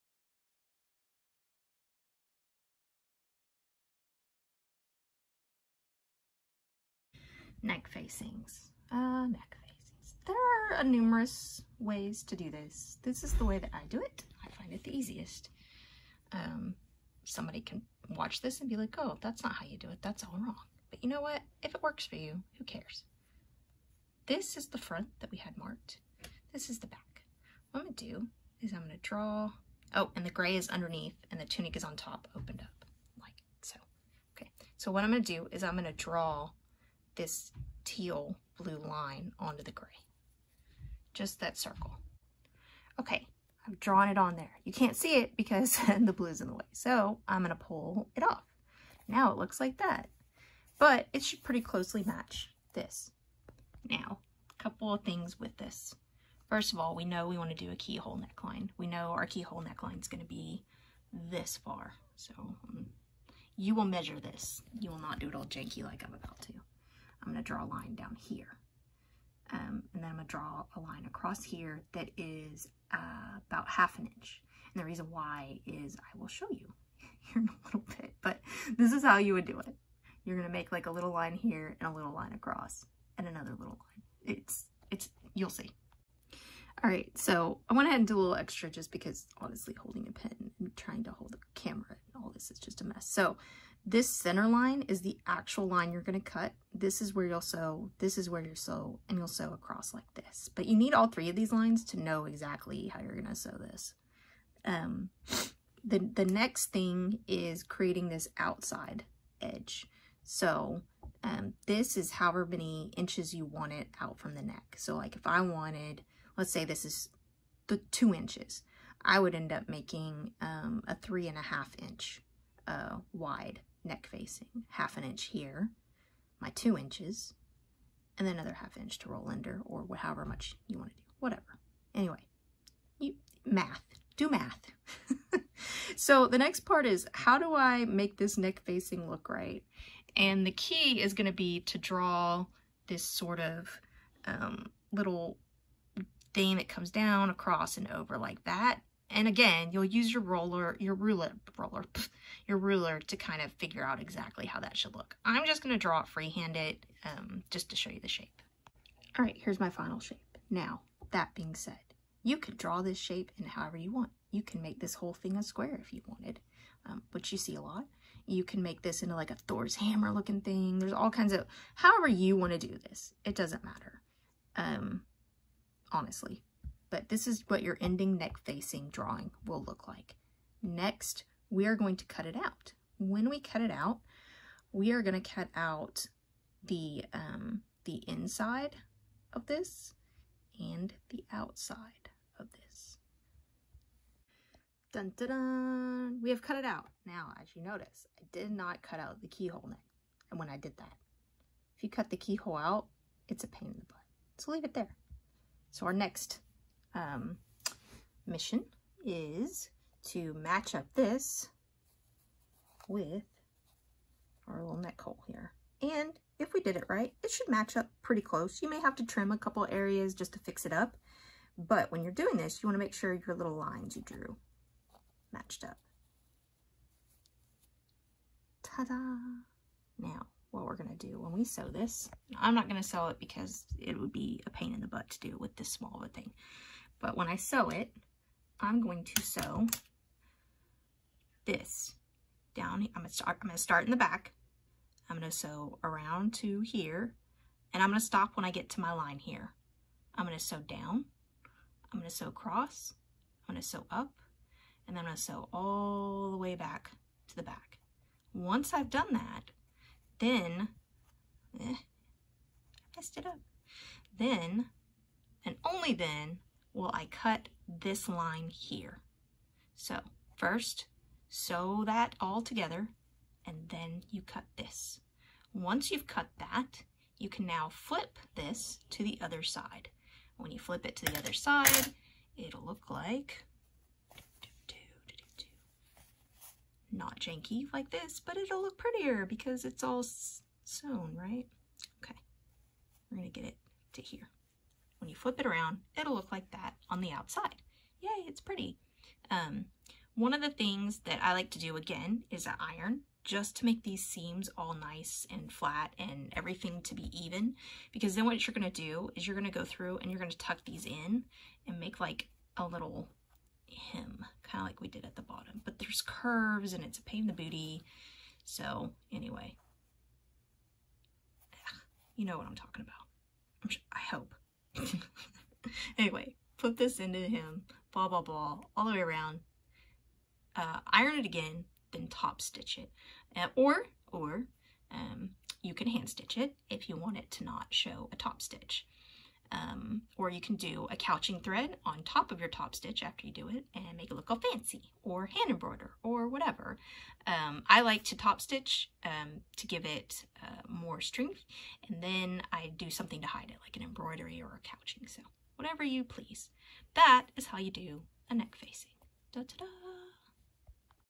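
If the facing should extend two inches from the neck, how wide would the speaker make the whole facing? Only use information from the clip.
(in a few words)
3.5 inches.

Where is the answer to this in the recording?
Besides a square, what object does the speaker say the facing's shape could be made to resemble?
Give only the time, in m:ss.
2:49.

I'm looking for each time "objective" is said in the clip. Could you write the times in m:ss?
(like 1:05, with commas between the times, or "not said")
not said.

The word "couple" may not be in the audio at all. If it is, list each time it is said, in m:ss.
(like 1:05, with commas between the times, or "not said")
0:54, 3:39.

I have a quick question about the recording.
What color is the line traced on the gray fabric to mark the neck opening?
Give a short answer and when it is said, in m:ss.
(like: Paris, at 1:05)
teal blue, at 0:37.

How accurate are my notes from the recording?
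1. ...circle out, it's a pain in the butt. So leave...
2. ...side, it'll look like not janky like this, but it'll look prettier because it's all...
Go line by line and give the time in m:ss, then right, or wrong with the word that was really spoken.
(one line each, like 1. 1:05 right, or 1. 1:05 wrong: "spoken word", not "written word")
1. 3:22 wrong: "keyhole", not "circle"
2. 4:41 right.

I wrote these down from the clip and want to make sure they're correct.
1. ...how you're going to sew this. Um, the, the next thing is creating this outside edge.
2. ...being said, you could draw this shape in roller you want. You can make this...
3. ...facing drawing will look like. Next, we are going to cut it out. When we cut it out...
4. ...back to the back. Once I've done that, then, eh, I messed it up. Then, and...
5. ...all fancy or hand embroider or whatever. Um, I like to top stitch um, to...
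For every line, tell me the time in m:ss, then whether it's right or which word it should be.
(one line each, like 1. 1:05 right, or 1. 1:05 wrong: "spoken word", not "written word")
1. 1:42 right
2. 2:41 wrong: "however", not "roller"
3. 2:58 right
4. 4:16 right
5. 5:44 right.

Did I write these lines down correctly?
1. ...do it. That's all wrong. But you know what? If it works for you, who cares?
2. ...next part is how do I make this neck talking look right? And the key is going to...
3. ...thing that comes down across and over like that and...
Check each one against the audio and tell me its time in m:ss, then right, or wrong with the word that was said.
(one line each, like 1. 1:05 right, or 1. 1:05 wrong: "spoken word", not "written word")
1. 0:19 right
2. 2:16 wrong: "facing", not "talking"
3. 2:26 right.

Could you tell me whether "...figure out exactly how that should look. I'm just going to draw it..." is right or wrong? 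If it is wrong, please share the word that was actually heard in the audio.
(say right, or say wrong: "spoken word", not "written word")
right.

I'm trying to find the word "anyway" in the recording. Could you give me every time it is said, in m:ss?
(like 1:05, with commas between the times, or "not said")
2:11, 5:19, 5:25.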